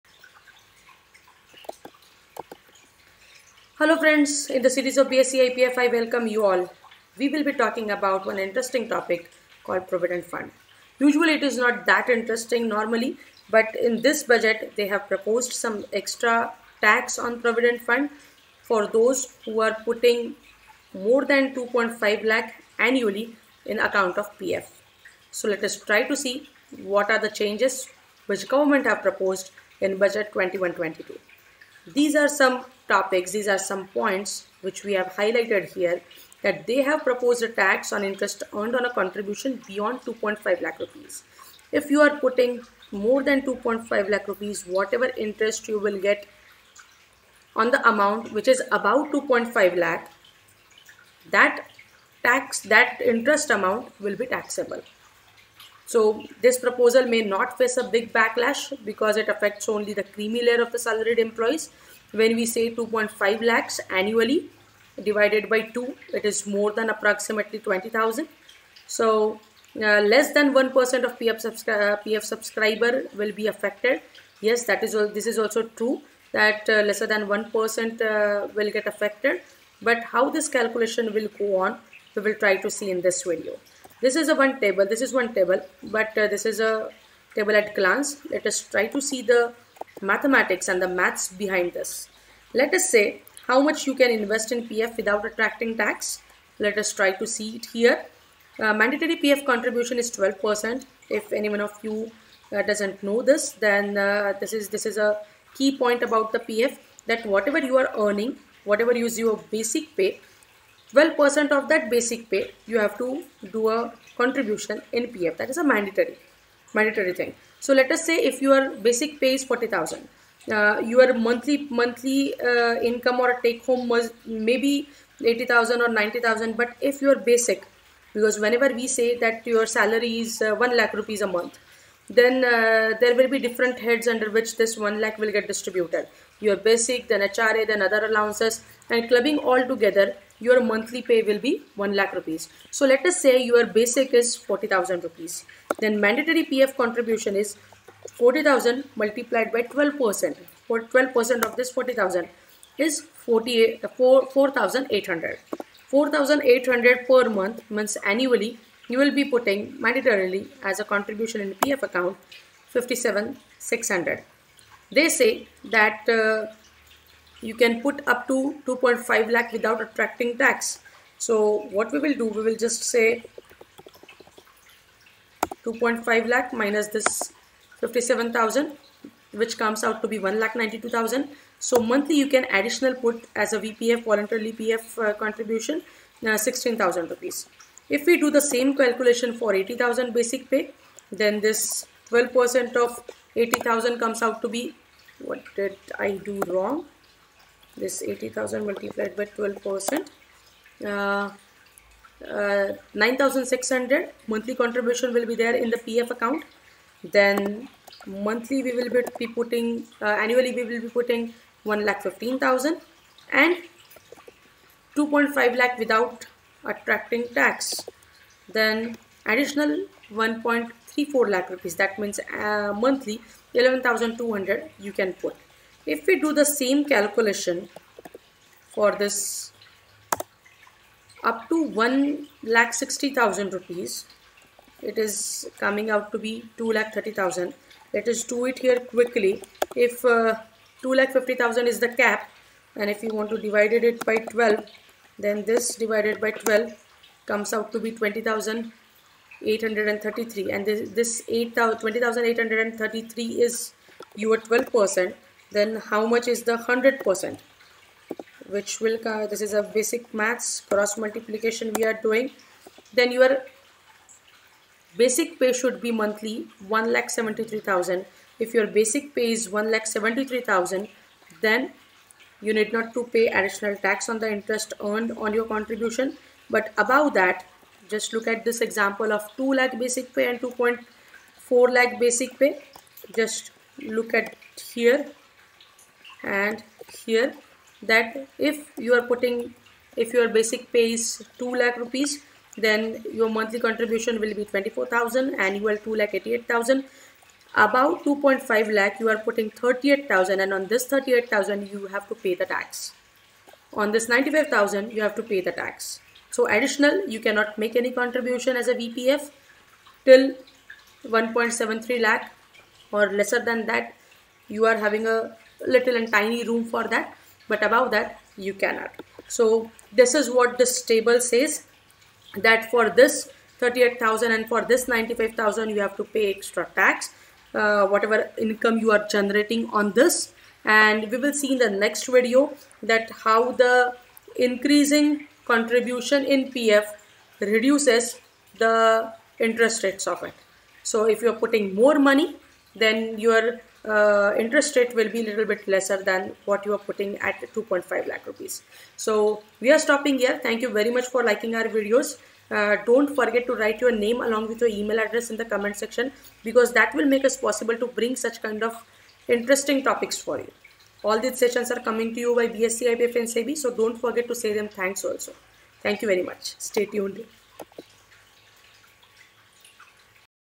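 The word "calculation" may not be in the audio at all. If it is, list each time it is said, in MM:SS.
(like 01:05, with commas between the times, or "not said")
01:20, 03:08, 03:46.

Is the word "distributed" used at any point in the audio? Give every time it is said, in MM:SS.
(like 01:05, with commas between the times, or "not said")
02:15.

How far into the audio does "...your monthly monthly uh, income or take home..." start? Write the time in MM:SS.
02:00.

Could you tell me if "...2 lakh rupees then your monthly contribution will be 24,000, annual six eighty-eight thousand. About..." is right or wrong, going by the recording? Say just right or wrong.
wrong.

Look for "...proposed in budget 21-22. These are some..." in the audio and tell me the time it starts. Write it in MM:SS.
00:29.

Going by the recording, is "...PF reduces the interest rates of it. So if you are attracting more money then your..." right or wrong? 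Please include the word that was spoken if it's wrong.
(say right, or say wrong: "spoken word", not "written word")
wrong: "putting", not "attracting".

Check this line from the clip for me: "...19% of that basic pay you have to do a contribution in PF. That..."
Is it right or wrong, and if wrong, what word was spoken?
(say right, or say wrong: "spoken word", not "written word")
wrong: "12", not "19".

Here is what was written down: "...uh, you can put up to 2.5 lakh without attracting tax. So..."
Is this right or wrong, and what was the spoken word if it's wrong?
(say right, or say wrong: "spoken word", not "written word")
right.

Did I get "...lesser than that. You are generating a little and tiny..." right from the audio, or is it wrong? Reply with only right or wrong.
wrong.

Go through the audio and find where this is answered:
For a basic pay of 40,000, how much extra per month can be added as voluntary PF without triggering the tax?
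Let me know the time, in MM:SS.
03:06.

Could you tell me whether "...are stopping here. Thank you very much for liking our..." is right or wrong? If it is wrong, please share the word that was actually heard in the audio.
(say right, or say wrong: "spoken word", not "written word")
right.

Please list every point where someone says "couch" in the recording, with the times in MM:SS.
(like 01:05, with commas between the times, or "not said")
not said.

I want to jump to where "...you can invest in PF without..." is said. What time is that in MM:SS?
01:33.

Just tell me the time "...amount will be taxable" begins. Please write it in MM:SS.
00:53.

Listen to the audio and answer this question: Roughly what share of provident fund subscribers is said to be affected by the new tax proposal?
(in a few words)
less than 1%.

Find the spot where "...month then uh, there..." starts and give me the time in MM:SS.
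02:11.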